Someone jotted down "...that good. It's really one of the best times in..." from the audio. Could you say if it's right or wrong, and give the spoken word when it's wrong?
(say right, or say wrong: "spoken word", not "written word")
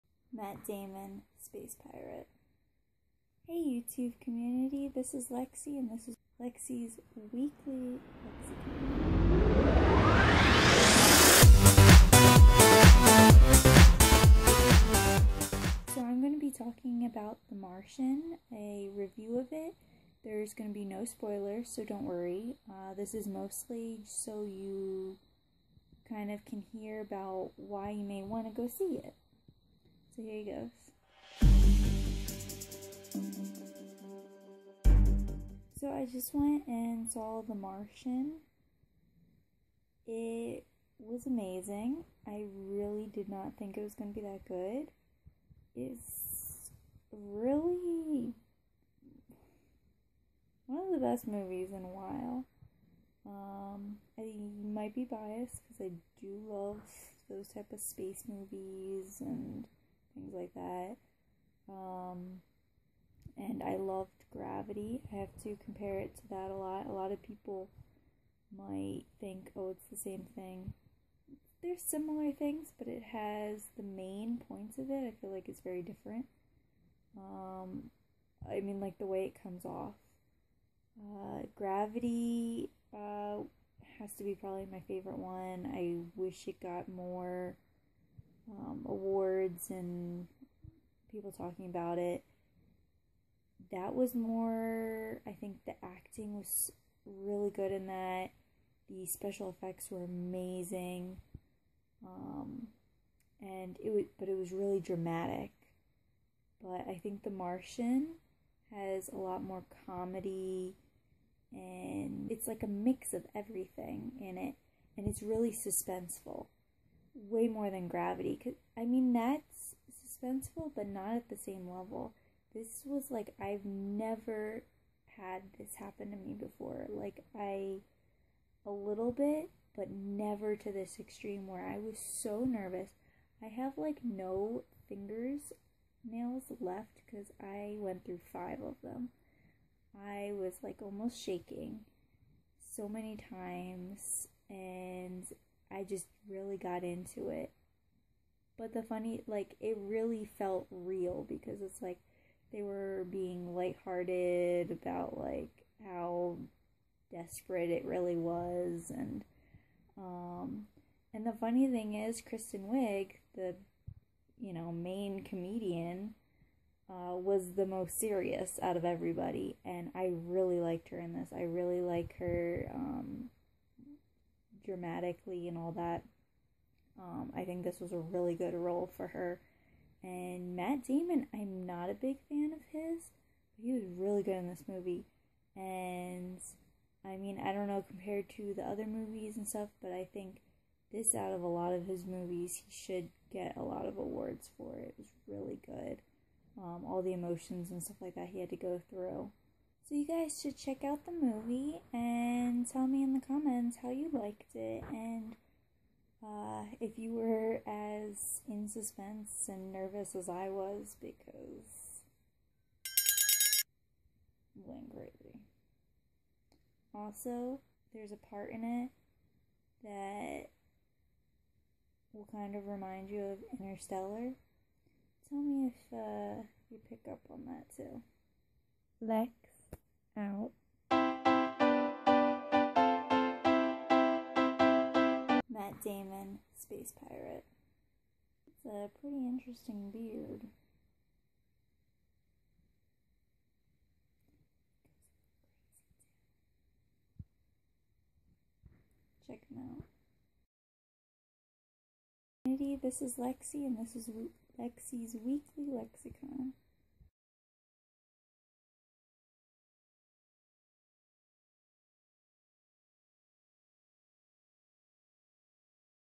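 wrong: "movies", not "times".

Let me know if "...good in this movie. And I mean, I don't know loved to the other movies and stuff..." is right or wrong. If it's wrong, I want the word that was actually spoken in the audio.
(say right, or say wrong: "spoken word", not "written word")
wrong: "compared", not "loved".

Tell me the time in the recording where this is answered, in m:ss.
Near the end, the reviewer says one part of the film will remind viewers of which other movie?
3:43.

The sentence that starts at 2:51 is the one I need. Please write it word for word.
I really like her um, dramatically and all that.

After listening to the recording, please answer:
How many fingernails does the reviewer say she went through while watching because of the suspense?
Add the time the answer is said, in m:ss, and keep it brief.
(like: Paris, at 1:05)
5, at 2:18.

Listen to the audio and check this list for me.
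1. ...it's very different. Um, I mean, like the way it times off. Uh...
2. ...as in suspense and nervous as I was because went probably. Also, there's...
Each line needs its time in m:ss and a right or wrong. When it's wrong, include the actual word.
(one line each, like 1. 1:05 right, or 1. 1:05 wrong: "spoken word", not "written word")
1. 1:15 wrong: "comes", not "times"
2. 3:27 wrong: "greatly", not "probably".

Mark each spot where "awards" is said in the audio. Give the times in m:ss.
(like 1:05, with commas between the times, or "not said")
1:28, 3:13.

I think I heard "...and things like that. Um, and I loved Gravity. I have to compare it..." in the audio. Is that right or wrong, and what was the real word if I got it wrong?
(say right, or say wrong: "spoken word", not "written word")
right.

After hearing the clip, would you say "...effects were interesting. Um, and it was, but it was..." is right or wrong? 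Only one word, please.
wrong.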